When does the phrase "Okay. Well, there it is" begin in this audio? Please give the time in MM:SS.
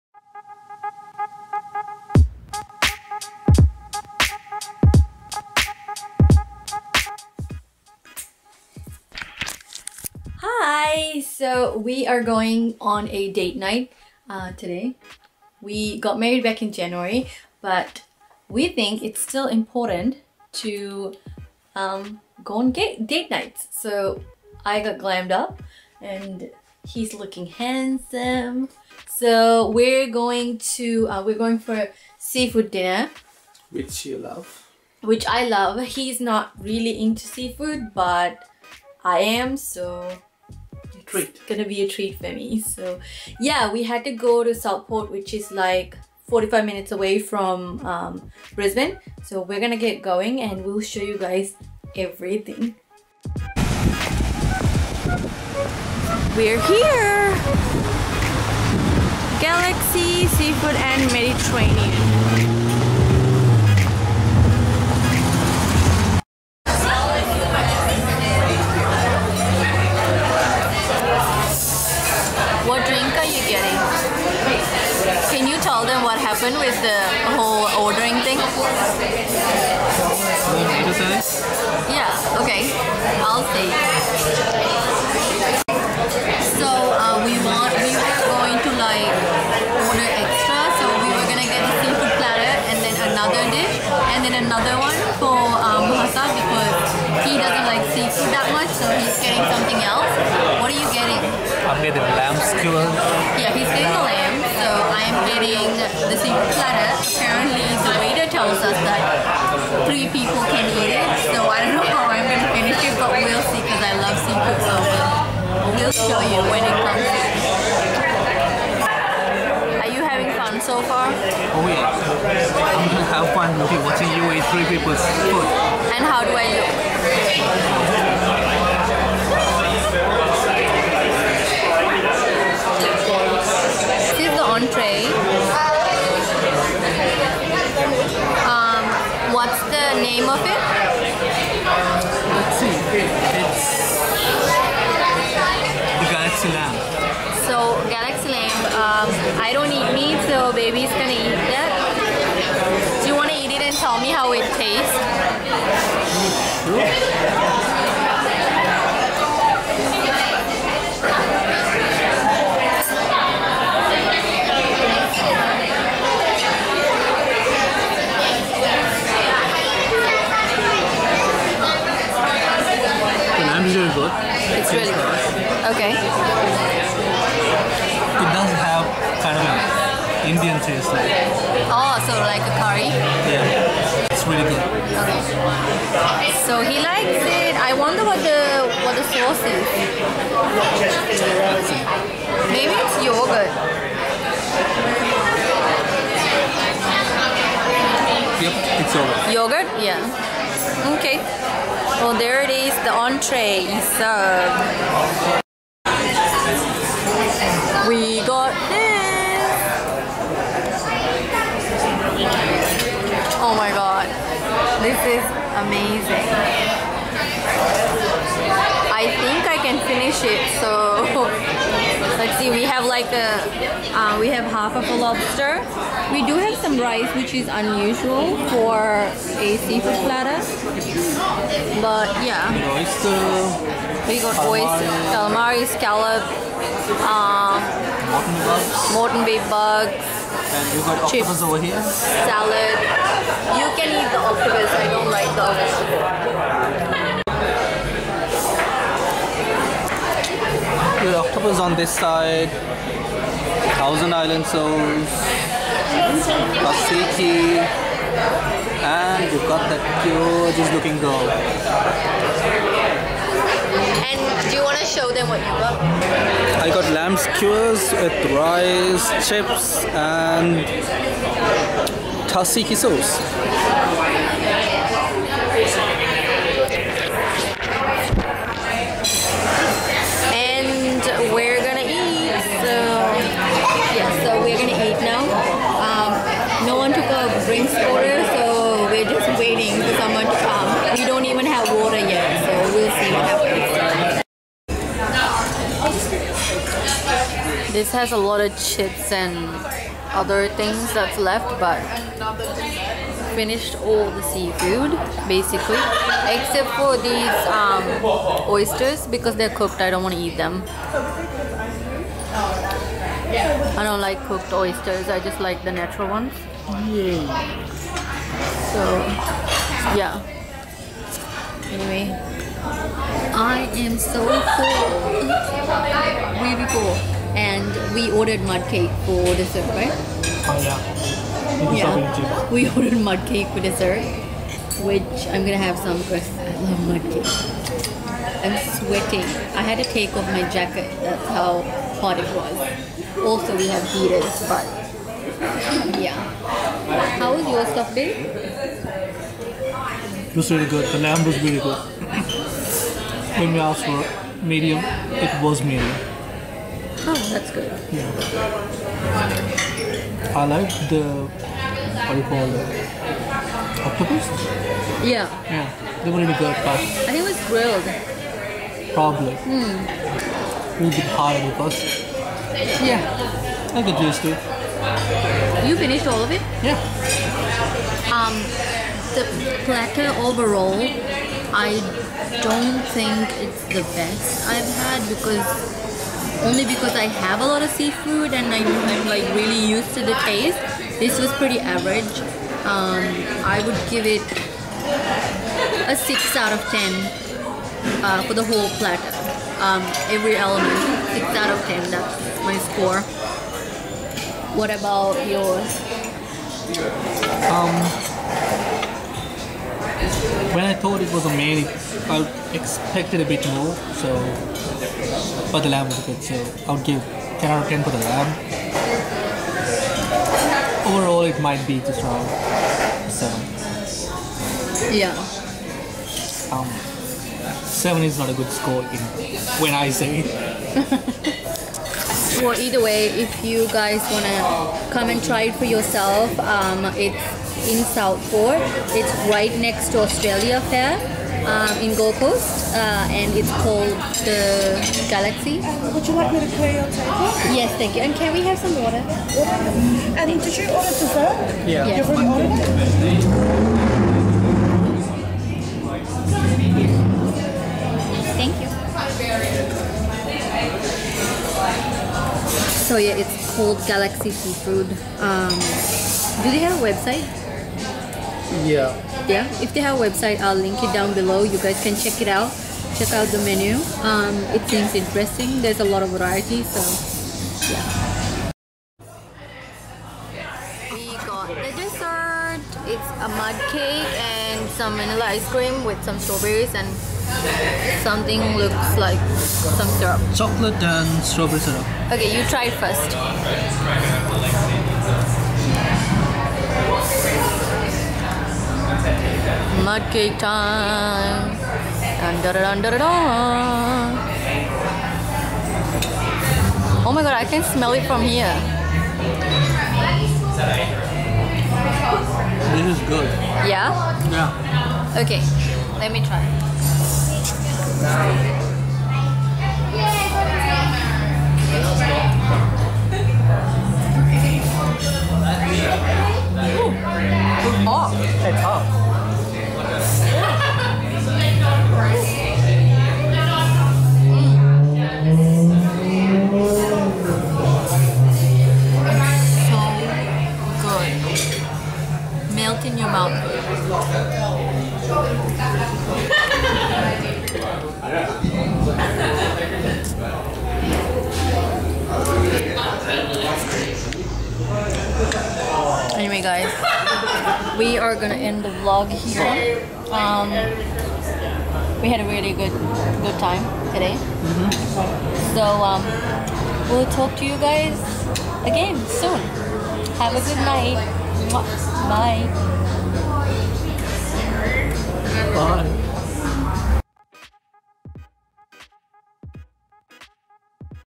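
03:20.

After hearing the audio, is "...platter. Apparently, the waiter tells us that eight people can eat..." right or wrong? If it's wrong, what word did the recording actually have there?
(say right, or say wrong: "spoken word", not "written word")
wrong: "three", not "eight".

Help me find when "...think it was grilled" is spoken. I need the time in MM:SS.
06:06.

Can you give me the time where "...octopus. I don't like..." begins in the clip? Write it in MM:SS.
04:04.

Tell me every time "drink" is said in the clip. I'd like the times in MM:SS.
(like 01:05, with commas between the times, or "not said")
01:12, 04:47.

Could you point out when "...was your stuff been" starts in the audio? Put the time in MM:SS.
05:47.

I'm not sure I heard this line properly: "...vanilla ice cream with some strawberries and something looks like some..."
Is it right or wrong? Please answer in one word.
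right.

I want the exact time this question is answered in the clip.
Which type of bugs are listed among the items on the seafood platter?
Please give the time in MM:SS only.
03:58.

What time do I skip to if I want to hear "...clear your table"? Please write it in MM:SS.
07:26.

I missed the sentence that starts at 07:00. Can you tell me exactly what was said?
Overall, it might be just around 7.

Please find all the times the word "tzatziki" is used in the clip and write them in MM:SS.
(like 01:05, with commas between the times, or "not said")
04:16, 04:32.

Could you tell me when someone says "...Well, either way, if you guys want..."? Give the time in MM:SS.
07:12.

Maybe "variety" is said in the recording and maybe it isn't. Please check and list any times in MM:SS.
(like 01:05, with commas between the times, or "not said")
07:56.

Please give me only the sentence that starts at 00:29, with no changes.
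So we're going to, uh, we're going for seafood dinner.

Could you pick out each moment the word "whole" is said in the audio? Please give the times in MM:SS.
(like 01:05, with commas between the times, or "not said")
01:17, 06:38.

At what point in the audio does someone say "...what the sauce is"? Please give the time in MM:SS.
03:08.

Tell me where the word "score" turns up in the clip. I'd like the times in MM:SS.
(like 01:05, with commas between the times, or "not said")
06:42, 07:08.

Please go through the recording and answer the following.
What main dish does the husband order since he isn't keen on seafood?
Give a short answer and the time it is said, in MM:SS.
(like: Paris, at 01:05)
Lamb skewer, at 01:42.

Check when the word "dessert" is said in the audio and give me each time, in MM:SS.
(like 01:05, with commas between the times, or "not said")
05:29, 05:33, 07:30, 08:01.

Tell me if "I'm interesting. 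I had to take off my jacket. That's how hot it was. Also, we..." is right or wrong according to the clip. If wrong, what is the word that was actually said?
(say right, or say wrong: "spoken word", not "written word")
wrong: "sweating", not "interesting".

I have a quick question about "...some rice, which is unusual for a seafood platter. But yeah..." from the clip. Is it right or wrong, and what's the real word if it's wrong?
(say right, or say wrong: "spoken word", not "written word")
right.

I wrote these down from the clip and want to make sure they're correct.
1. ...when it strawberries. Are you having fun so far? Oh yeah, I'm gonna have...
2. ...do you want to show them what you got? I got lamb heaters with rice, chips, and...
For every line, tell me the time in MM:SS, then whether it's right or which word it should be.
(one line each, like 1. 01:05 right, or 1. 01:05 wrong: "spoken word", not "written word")
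1. 01:56 wrong: "comes", not "strawberries"
2. 04:24 wrong: "skewers", not "heaters".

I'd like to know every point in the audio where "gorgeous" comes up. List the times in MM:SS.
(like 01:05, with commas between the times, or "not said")
04:20.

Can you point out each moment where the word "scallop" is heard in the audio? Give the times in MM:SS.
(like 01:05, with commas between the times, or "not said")
03:55.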